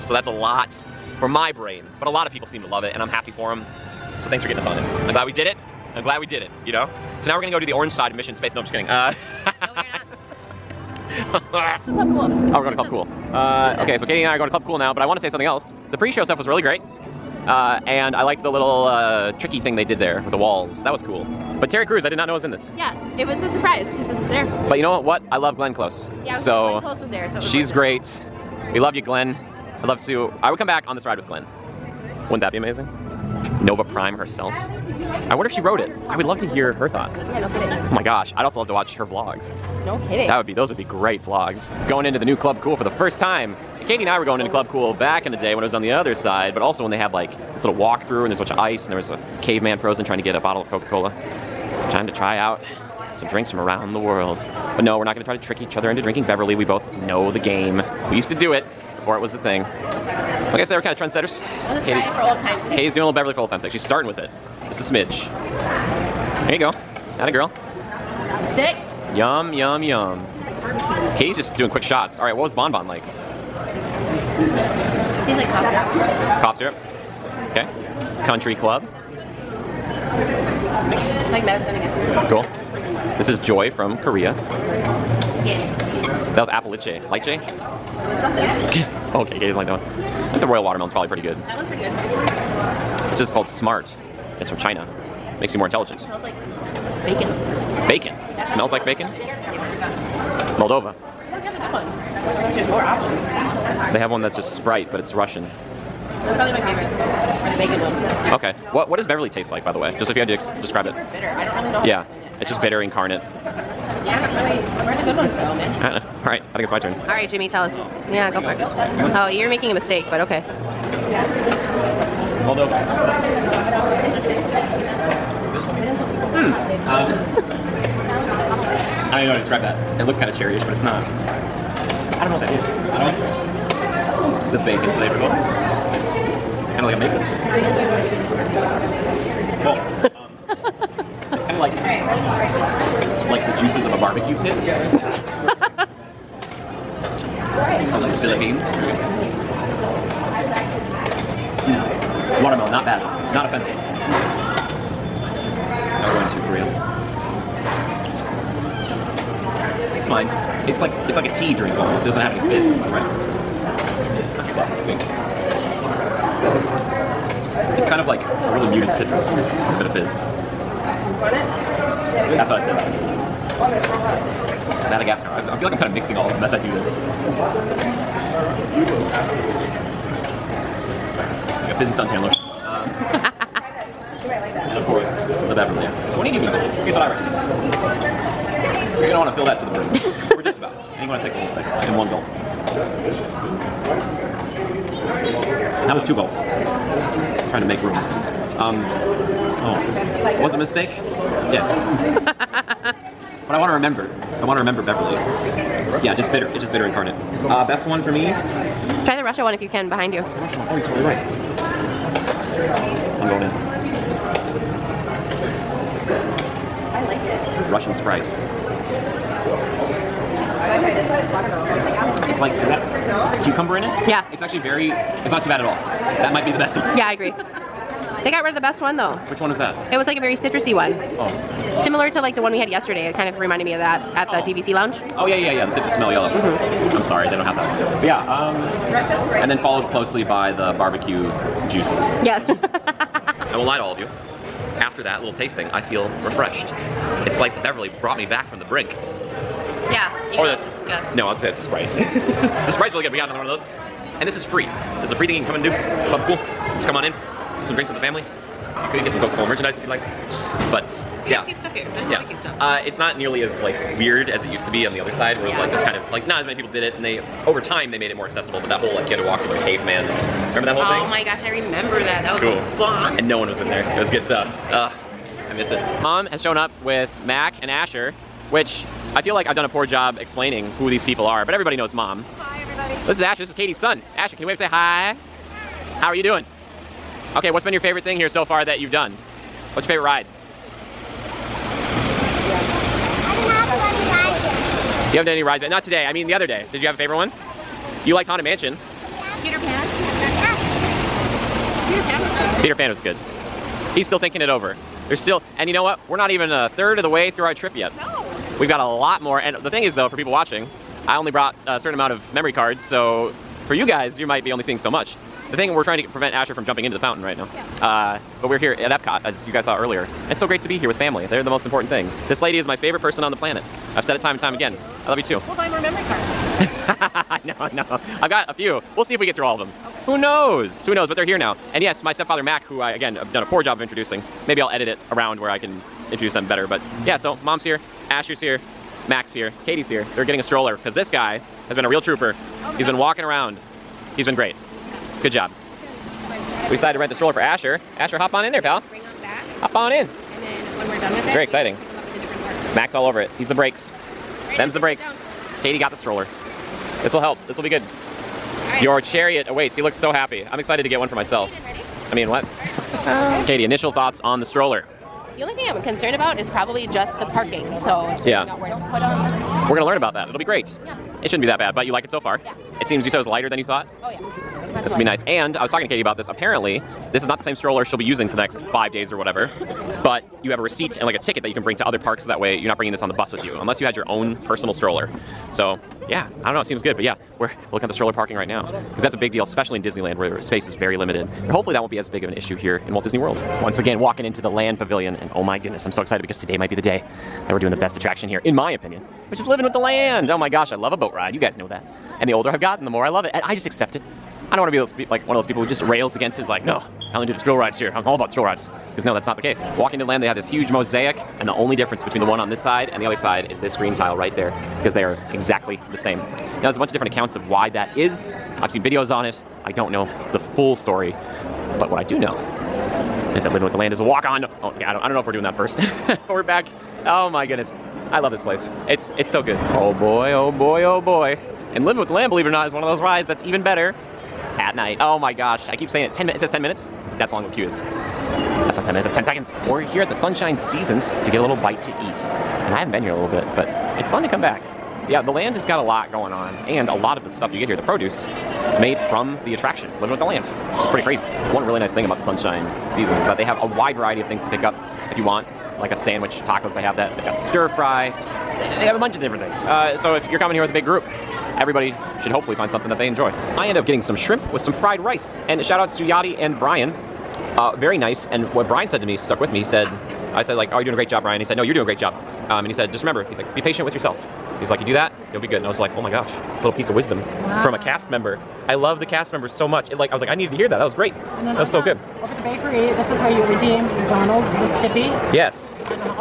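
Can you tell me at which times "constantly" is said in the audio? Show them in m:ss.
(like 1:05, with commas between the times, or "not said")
not said.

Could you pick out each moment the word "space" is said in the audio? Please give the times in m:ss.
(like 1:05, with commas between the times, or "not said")
0:08, 6:30.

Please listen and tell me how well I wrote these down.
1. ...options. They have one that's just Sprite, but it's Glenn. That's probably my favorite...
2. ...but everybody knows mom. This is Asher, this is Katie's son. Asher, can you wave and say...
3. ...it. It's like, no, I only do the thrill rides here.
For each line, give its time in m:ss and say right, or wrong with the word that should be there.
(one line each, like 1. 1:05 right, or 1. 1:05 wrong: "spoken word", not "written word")
1. 1:42 wrong: "Russian", not "Glenn"
2. 4:41 right
3. 6:46 right.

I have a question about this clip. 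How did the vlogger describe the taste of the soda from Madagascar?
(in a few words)
Fizzy suntan lotion.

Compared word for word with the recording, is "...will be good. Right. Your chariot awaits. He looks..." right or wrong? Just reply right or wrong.
right.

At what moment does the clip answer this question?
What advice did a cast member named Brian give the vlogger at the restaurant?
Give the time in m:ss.
7:53.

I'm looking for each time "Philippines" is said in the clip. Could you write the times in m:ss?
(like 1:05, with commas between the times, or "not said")
2:28.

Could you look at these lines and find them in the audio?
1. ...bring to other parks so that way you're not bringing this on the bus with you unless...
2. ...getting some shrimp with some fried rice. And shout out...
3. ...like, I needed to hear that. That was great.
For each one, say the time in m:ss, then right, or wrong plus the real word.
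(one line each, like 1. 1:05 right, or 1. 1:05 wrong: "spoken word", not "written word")
1. 6:21 right
2. 7:43 right
3. 8:00 right.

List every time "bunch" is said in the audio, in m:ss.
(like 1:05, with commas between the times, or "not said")
0:48, 6:56, 7:38.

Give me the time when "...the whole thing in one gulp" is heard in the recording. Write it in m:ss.
3:11.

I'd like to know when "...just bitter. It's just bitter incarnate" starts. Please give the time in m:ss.
3:26.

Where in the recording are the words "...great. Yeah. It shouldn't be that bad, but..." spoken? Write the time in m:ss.
6:10.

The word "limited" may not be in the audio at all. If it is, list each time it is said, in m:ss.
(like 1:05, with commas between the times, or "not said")
6:30.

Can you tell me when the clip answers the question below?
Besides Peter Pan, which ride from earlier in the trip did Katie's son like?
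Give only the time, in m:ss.
4:58.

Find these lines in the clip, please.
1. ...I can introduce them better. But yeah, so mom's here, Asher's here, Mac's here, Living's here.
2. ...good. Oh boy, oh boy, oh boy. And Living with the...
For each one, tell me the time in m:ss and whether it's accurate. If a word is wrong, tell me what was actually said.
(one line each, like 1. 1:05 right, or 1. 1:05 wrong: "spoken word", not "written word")
1. 5:35 wrong: "Katie", not "Living"
2. 7:09 right.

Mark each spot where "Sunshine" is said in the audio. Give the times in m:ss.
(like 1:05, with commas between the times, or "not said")
7:20, 7:32.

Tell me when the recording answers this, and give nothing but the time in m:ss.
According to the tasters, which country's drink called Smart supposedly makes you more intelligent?
1:34.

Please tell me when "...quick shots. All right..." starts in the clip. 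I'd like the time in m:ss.
1:11.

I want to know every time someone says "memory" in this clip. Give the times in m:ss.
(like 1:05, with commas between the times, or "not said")
5:12, 5:25.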